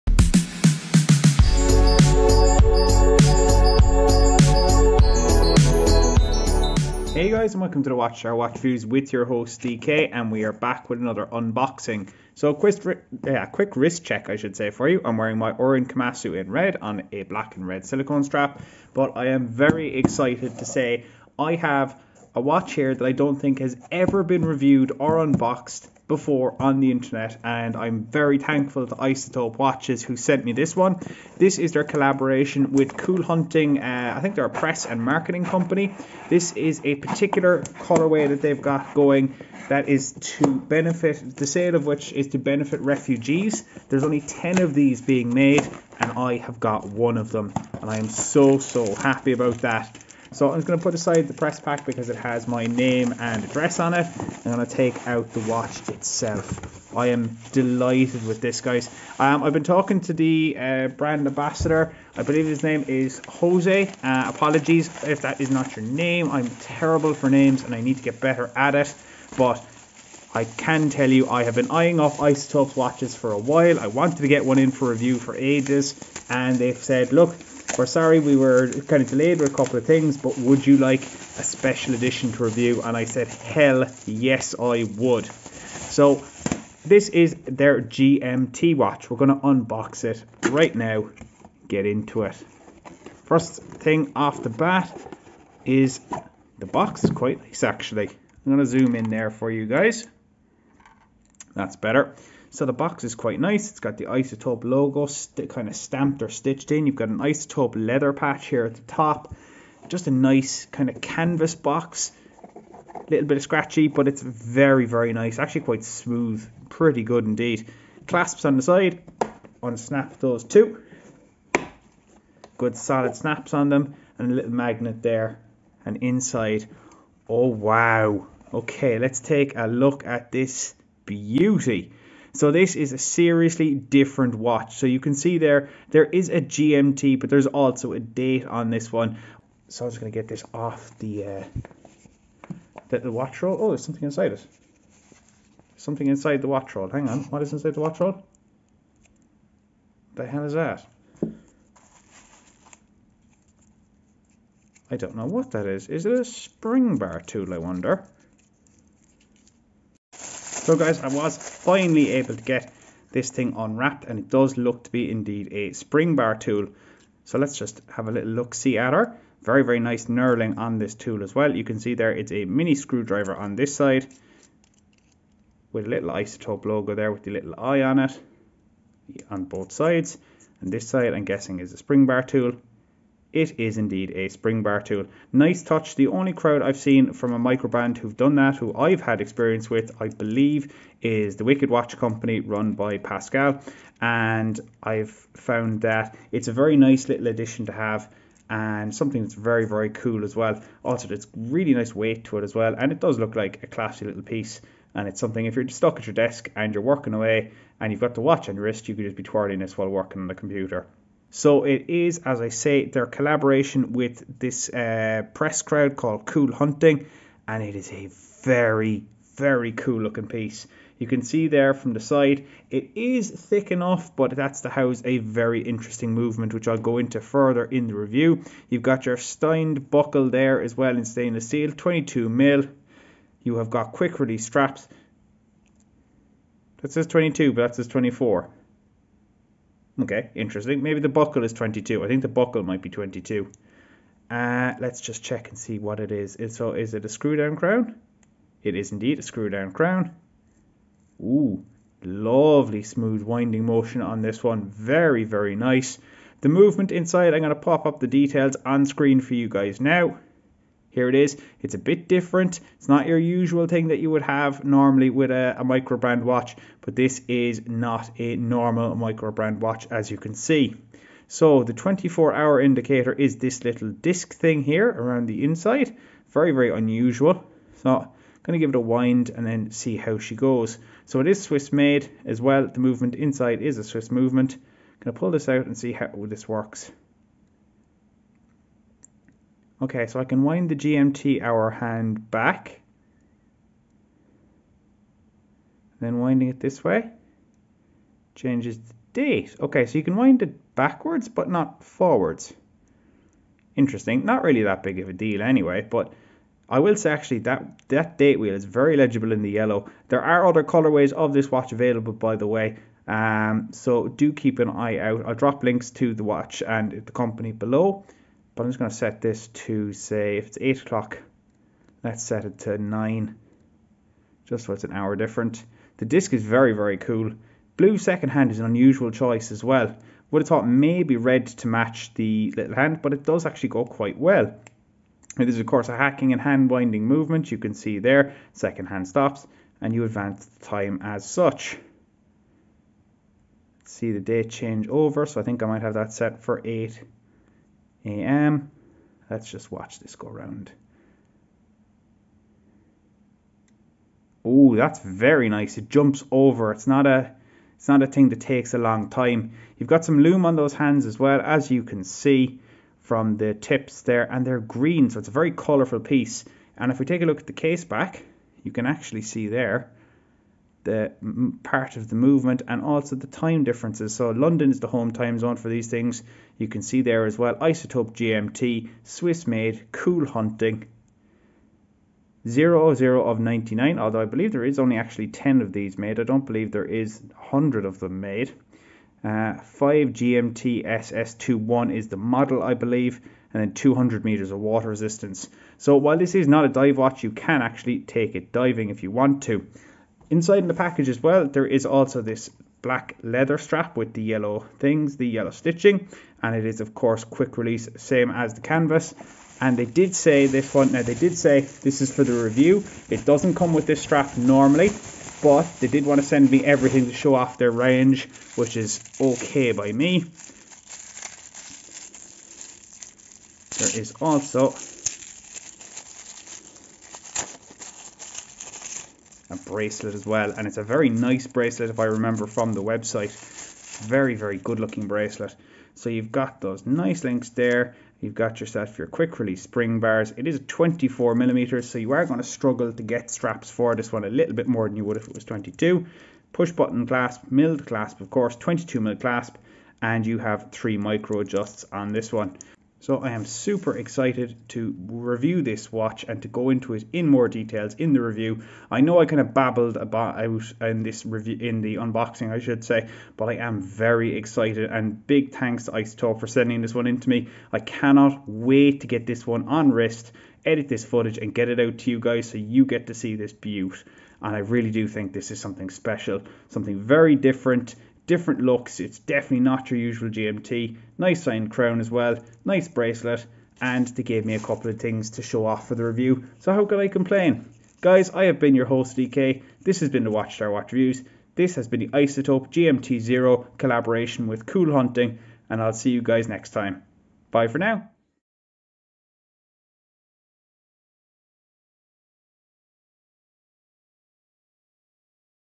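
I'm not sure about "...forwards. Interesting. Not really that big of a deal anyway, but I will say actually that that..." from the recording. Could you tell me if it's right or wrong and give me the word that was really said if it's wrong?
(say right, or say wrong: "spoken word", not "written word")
right.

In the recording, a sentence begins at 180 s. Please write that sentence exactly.
And this side I'm guessing is a spring bar tool.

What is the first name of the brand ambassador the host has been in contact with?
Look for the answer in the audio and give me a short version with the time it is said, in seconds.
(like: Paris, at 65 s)
Jose, at 63 s.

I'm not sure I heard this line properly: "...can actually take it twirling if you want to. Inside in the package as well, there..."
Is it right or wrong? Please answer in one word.
wrong.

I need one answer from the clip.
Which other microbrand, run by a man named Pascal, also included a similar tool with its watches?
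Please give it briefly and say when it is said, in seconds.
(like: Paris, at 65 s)
Wicked Watch Company, at 191 s.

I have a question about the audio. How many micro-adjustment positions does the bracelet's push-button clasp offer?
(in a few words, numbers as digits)
3.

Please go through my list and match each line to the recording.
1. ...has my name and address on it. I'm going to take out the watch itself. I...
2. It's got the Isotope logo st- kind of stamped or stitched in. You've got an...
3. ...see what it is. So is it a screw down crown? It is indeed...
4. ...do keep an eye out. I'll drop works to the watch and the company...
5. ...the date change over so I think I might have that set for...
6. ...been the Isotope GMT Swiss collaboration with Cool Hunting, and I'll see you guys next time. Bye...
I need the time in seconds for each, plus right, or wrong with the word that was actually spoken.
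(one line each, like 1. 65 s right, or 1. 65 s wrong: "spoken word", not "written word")
1. 52 s right
2. 103 s right
3. 245 s right
4. 314 s wrong: "links", not "works"
5. 344 s right
6. 491 s wrong: "Zero", not "Swiss".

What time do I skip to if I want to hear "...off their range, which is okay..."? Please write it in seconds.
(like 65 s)
417 s.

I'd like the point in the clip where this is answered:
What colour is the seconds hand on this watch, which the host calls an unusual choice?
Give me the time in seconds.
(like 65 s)
327 s.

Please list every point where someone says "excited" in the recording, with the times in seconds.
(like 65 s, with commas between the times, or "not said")
19 s, 453 s, 464 s.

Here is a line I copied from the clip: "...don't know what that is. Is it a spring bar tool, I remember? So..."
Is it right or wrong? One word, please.
wrong.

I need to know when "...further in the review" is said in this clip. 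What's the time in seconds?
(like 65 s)
227 s.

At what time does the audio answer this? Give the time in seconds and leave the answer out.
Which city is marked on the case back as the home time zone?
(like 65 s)
374 s.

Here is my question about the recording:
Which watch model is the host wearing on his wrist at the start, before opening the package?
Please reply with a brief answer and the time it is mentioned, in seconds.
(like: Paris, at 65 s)
Orient Kamasu, at 15 s.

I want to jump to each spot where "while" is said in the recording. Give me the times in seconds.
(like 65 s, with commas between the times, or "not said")
73 s, 209 s, 395 s.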